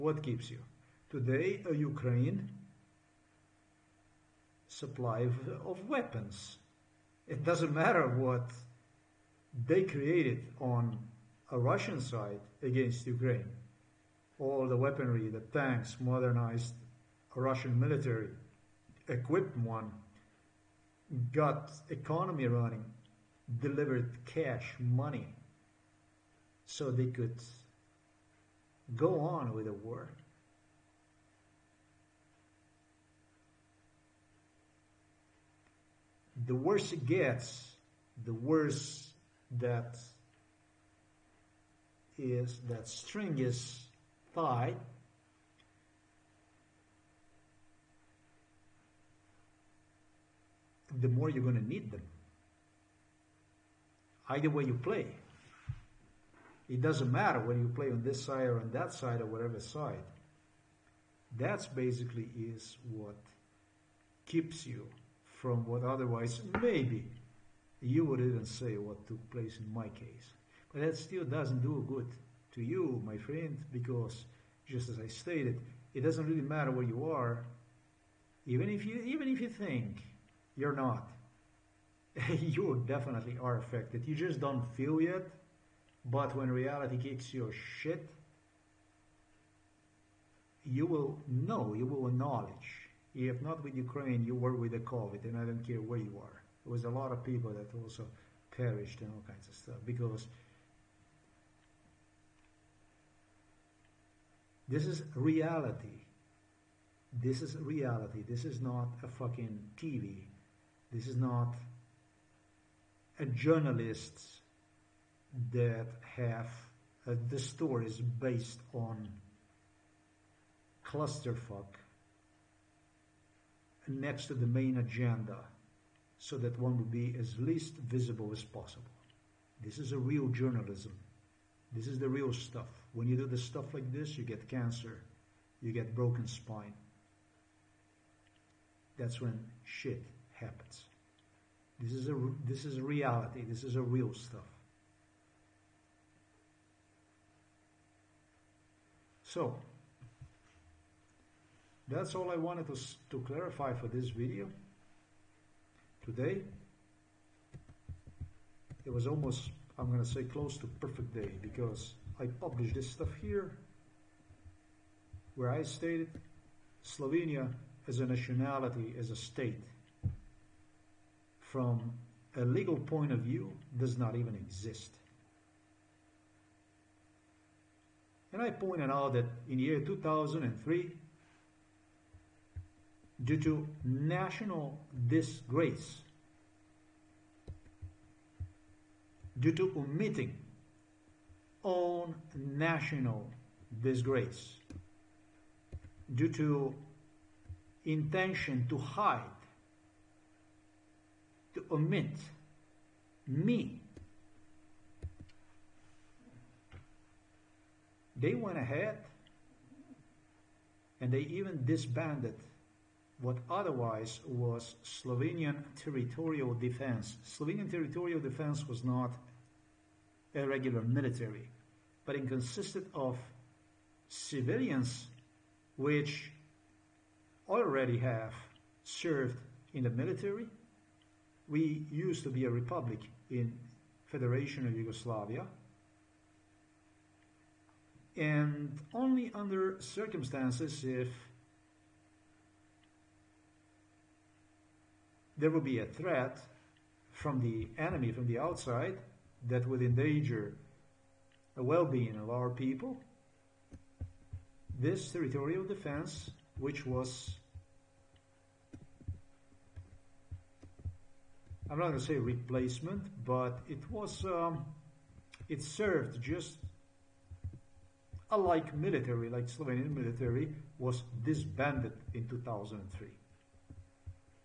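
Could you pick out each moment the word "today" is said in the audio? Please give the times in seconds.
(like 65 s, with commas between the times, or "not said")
1 s, 156 s.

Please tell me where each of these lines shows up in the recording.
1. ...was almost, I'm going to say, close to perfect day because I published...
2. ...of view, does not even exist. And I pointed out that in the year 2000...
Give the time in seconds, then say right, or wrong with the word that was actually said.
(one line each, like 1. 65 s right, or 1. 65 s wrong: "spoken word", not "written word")
1. 158 s right
2. 173 s wrong: "2003", not "2000".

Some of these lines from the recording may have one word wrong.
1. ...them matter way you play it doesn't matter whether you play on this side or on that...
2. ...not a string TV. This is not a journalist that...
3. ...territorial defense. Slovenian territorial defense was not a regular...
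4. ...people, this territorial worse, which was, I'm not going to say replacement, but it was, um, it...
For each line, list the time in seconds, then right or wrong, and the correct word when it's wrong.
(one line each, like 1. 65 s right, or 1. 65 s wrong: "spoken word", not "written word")
1. 51 s wrong: "either", not "matter"
2. 108 s wrong: "fucking", not "string"
3. 215 s right
4. 252 s wrong: "defense", not "worse".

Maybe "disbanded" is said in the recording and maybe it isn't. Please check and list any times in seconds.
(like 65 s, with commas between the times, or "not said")
211 s, 271 s.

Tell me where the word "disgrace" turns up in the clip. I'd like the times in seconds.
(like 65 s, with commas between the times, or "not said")
185 s, 193 s.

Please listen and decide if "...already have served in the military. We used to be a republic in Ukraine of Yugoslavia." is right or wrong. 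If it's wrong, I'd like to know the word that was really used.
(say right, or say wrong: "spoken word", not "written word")
wrong: "Federation", not "Ukraine".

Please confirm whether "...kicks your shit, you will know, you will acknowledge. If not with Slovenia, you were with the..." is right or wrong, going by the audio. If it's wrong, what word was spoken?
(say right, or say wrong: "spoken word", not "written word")
wrong: "Ukraine", not "Slovenia".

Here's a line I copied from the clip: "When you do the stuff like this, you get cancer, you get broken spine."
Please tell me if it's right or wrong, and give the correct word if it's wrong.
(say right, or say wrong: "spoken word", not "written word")
right.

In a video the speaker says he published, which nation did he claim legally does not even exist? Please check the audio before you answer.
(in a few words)
Slovenia.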